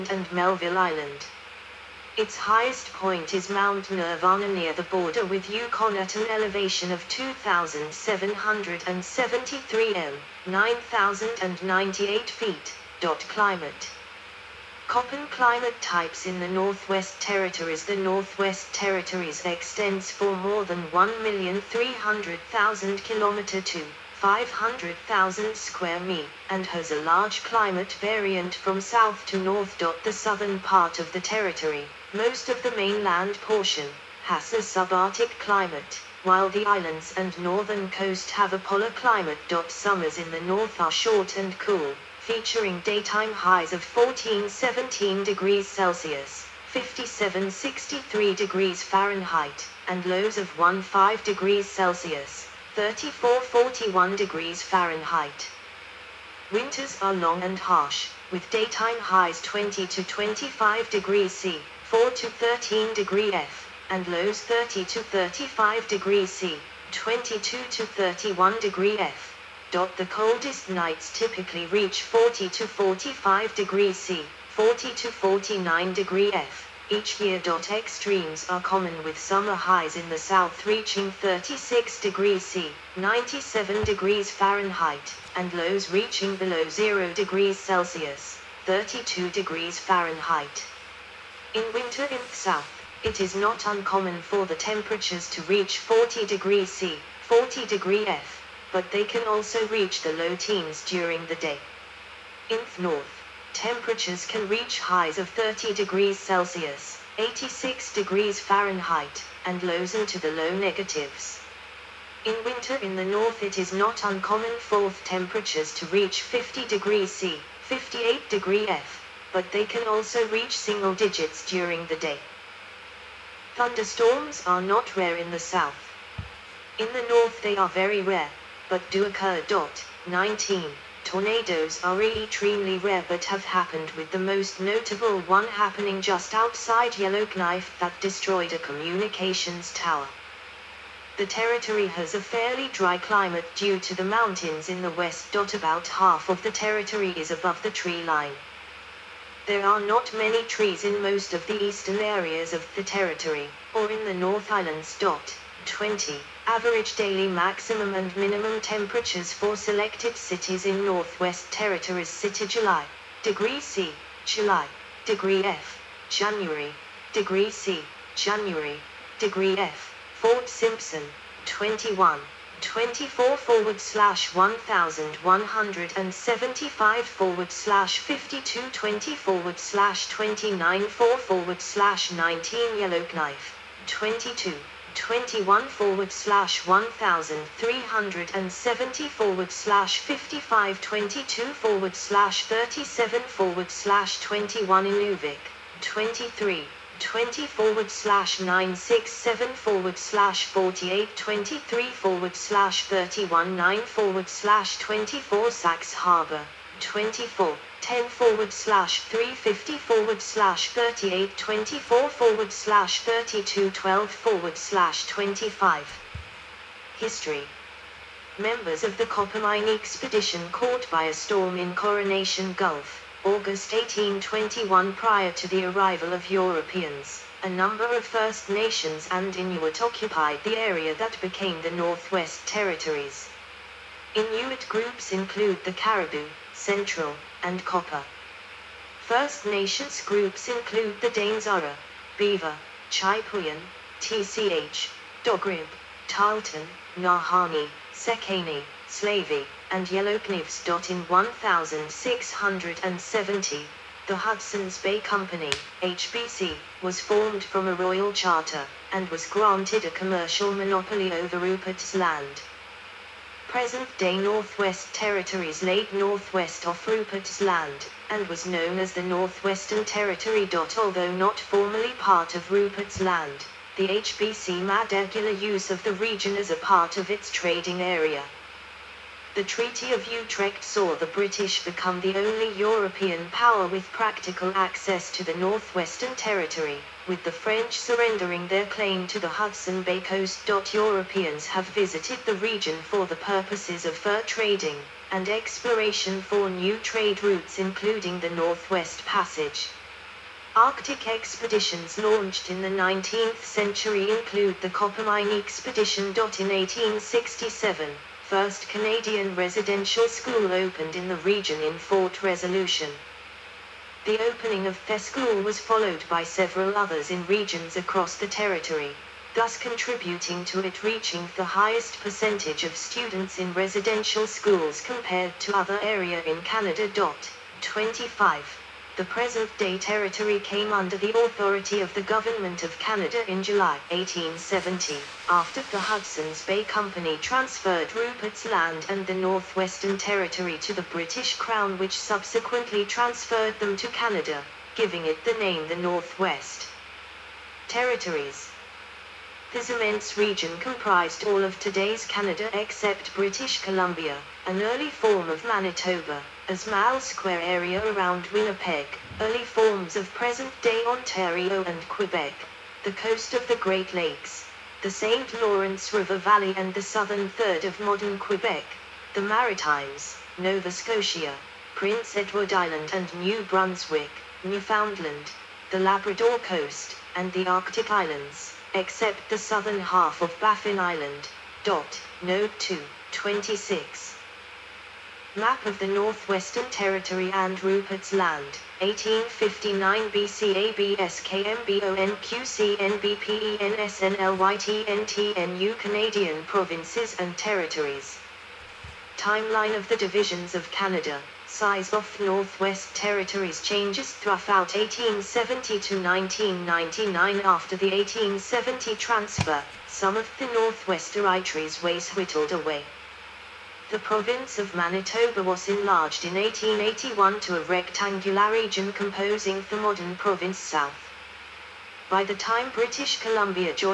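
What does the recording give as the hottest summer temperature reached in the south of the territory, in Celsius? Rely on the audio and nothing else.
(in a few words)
36 degrees C.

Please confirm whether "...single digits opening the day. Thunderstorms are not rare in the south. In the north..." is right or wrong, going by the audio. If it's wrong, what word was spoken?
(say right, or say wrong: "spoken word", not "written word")
wrong: "during", not "opening".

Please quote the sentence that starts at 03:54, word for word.
Inuit groups include the Caribou, Central, and copper.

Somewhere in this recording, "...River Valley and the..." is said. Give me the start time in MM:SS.
06:05.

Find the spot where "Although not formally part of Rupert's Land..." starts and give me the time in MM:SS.
04:30.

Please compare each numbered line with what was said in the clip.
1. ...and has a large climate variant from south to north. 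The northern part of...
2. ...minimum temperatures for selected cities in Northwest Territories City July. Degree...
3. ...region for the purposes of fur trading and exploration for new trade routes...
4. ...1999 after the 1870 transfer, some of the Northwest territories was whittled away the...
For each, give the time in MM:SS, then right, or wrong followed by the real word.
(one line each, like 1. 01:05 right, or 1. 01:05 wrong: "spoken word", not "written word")
1. 00:26 wrong: "southern", not "northern"
2. 02:38 right
3. 04:52 right
4. 06:46 right.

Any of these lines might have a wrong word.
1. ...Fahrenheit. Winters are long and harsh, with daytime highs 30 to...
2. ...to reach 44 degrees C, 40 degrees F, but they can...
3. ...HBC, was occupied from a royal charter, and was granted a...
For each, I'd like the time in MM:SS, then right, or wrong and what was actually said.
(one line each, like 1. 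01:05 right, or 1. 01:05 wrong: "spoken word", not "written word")
1. 00:54 wrong: "20", not "30"
2. 01:35 wrong: "40", not "44"
3. 04:15 wrong: "formed", not "occupied".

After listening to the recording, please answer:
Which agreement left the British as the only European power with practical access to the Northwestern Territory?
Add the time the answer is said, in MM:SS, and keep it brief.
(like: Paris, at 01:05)
Treaty of Utrecht, at 04:39.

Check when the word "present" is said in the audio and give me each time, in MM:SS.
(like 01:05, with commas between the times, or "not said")
04:23, 05:29, 06:00.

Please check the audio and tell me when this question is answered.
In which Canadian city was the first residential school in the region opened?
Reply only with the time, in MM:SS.
05:11.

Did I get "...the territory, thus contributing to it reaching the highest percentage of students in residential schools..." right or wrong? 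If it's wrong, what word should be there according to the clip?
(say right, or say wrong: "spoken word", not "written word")
right.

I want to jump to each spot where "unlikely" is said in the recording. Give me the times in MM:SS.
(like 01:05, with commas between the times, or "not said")
not said.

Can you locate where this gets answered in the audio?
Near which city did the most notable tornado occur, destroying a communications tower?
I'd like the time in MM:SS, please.
02:16.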